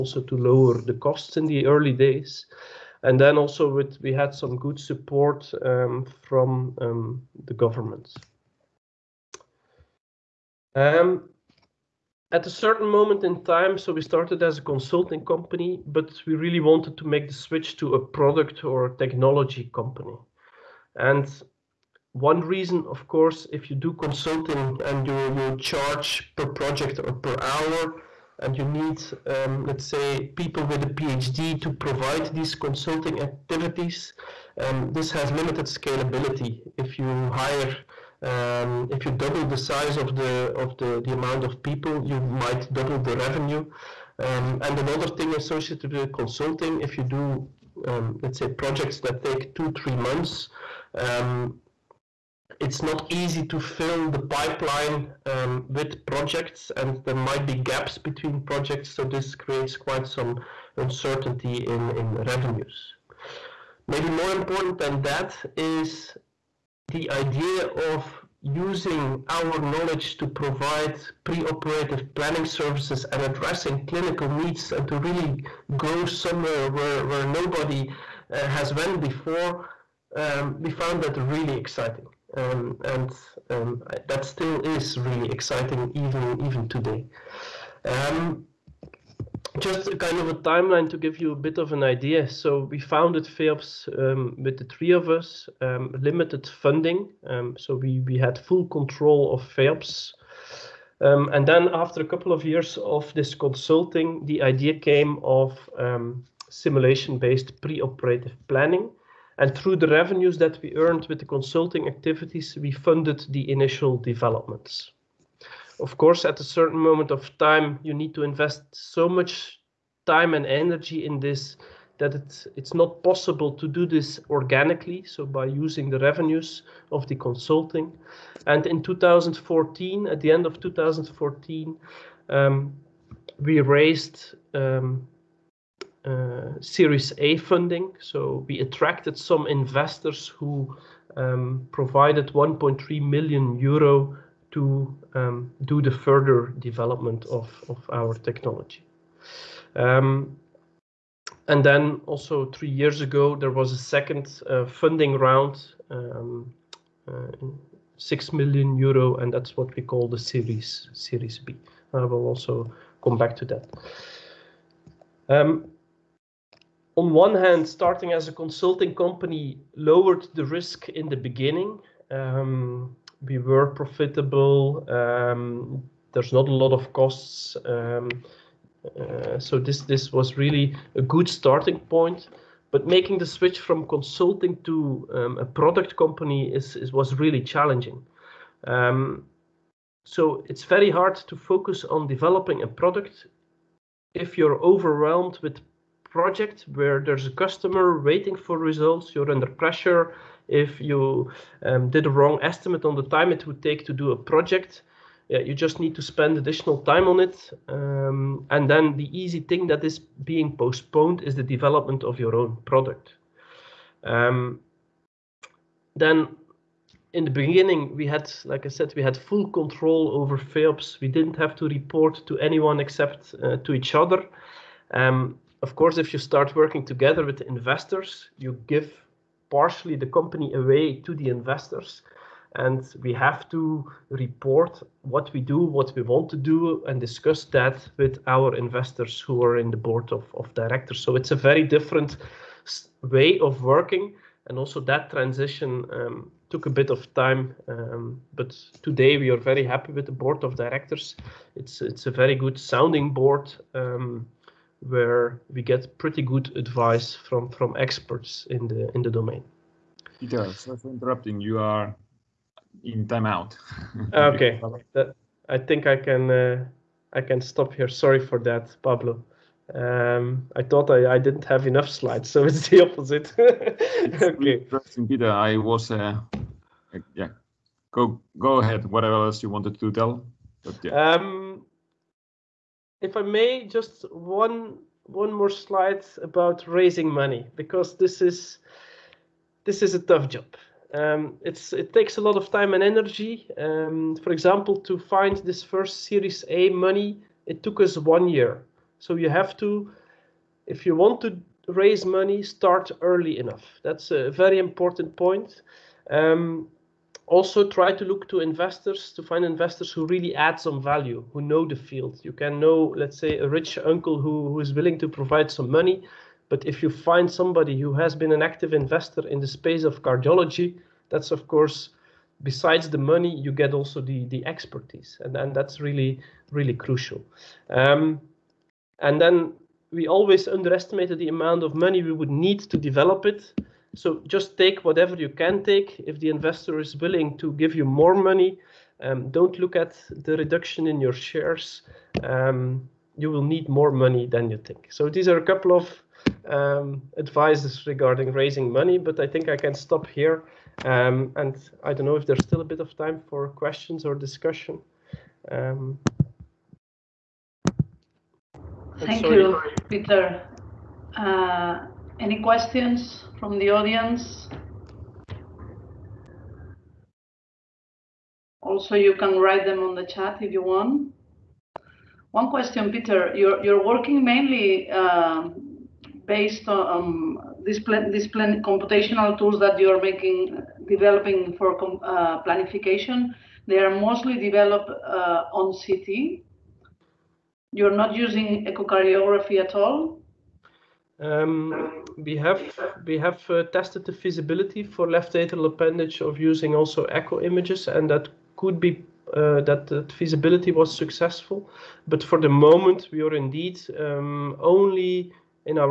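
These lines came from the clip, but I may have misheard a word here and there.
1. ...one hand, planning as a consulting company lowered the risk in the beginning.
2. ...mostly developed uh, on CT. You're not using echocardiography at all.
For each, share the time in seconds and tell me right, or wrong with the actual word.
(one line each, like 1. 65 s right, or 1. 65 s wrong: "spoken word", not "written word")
1. 167 s wrong: "starting", not "planning"
2. 383 s right.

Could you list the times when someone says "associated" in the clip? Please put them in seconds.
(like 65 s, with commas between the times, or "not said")
45 s.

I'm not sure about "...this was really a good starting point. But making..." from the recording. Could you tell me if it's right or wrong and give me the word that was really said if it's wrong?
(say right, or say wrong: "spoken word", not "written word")
right.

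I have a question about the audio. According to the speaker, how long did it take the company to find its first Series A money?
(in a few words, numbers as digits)
one year.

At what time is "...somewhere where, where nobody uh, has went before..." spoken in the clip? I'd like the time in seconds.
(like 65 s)
76 s.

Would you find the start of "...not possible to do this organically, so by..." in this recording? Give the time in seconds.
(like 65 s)
122 s.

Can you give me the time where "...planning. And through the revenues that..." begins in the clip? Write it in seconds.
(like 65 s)
108 s.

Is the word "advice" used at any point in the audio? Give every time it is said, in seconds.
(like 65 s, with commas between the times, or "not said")
256 s, 347 s.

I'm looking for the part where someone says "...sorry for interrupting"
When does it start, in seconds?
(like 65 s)
260 s.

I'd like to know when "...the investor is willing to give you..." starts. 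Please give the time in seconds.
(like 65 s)
336 s.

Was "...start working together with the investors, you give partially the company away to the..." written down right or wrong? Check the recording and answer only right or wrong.
right.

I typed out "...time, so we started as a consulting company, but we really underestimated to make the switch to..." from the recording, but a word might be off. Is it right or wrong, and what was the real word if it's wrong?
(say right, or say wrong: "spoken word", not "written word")
wrong: "wanted", not "underestimated".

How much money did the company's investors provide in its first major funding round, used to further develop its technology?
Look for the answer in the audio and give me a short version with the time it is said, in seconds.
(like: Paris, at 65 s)
1.3 million euro, at 142 s.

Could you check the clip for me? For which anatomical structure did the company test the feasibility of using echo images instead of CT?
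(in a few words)
left atrial appendage.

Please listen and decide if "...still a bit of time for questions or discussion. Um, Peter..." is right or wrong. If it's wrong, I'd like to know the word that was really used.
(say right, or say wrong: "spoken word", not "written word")
wrong: "Thank", not "Peter".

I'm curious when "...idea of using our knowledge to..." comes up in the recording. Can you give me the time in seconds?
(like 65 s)
67 s.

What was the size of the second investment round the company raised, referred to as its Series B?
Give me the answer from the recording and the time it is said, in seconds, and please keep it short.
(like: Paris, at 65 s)
6 million euro, at 157 s.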